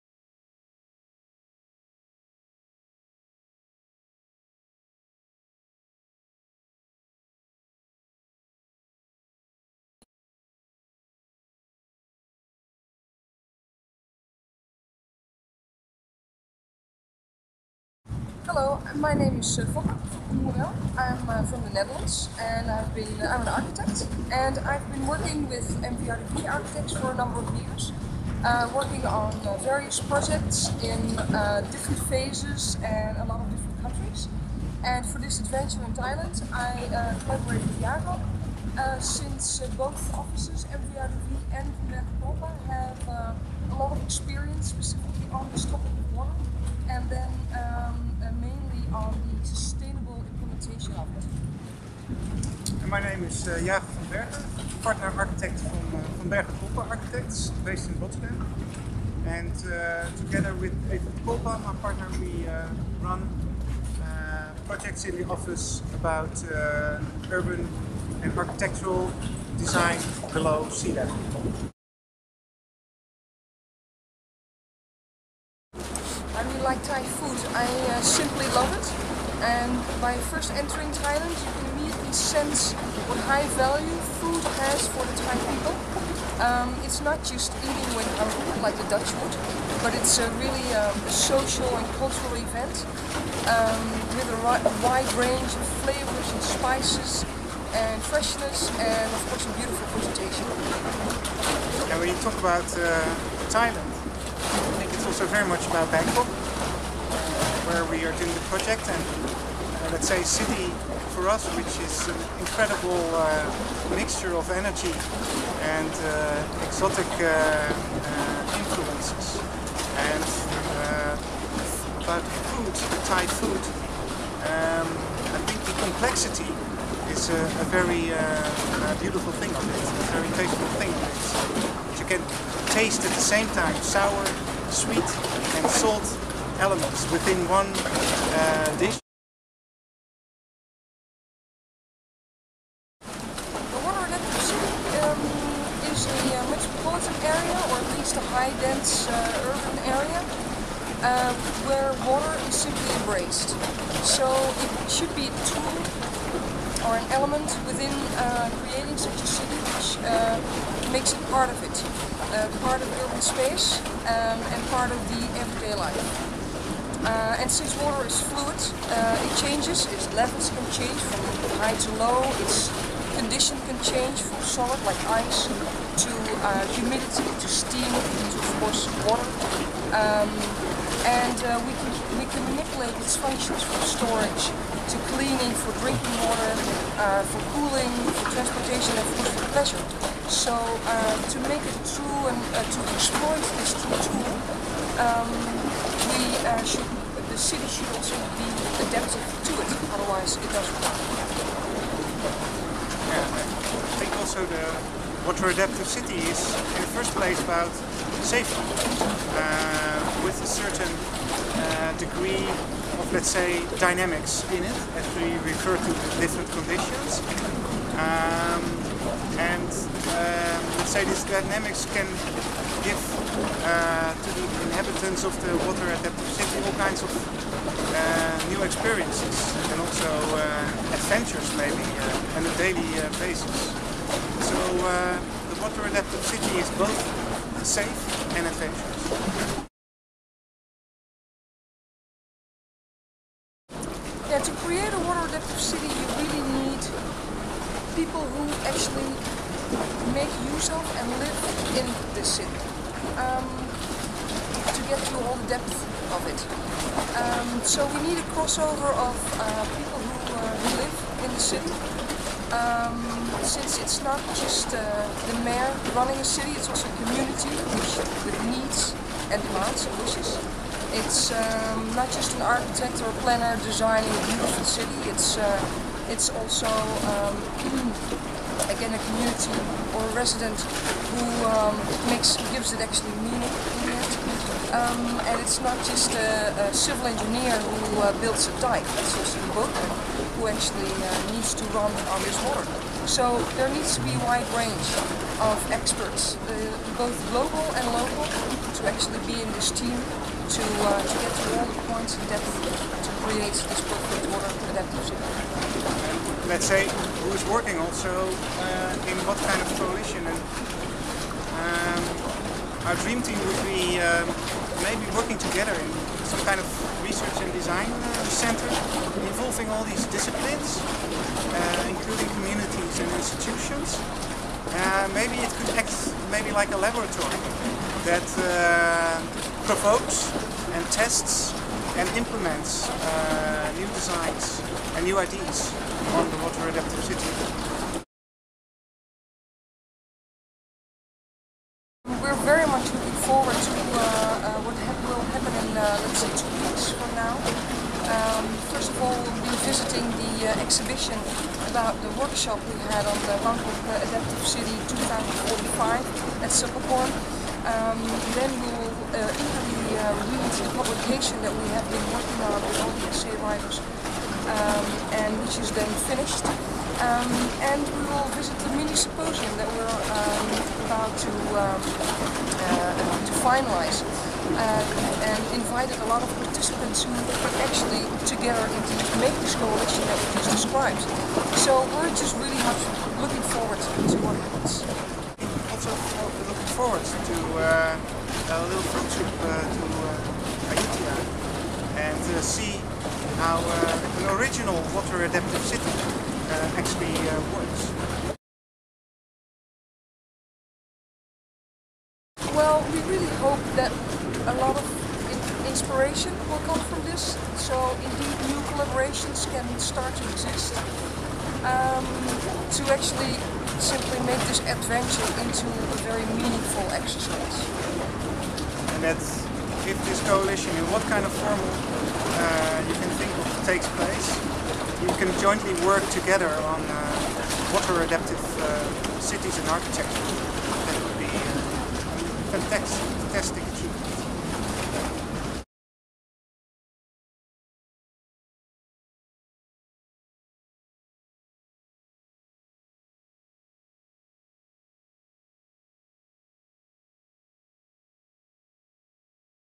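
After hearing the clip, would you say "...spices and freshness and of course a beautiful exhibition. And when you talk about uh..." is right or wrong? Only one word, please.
wrong.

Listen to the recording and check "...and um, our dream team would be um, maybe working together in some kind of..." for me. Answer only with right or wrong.
right.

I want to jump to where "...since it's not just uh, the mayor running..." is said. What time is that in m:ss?
4:23.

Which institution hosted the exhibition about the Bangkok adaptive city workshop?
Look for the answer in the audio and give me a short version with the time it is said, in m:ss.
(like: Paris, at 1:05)
Silpakorn, at 5:56.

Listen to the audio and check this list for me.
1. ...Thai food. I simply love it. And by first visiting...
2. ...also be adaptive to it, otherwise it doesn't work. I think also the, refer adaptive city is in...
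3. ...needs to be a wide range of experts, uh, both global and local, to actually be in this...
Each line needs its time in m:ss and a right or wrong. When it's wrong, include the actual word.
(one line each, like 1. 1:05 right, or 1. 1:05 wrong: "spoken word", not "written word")
1. 1:16 wrong: "entering", not "visiting"
2. 3:17 wrong: "water", not "refer"
3. 4:53 right.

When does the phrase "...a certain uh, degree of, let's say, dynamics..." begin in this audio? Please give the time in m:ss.
3:30.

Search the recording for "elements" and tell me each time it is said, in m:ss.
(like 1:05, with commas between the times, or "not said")
2:16, 2:37.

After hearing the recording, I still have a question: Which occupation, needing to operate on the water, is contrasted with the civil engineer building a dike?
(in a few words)
boatman.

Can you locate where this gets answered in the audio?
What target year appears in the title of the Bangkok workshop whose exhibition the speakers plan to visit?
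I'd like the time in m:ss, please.
5:54.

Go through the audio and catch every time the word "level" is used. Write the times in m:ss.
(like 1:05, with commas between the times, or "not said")
1:10, 2:50.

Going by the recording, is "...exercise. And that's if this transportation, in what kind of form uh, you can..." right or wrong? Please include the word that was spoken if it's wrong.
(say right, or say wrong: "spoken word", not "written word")
wrong: "coalition", not "transportation".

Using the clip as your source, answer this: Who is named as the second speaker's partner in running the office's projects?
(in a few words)
Evert Kolpa.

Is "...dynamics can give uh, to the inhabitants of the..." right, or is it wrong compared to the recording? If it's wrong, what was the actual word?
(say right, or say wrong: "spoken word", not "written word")
right.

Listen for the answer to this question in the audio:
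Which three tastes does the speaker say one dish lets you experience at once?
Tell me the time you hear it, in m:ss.
2:13.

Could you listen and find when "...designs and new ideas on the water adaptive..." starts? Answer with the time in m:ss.
5:33.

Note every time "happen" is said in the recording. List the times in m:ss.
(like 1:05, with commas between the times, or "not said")
5:45, 6:24.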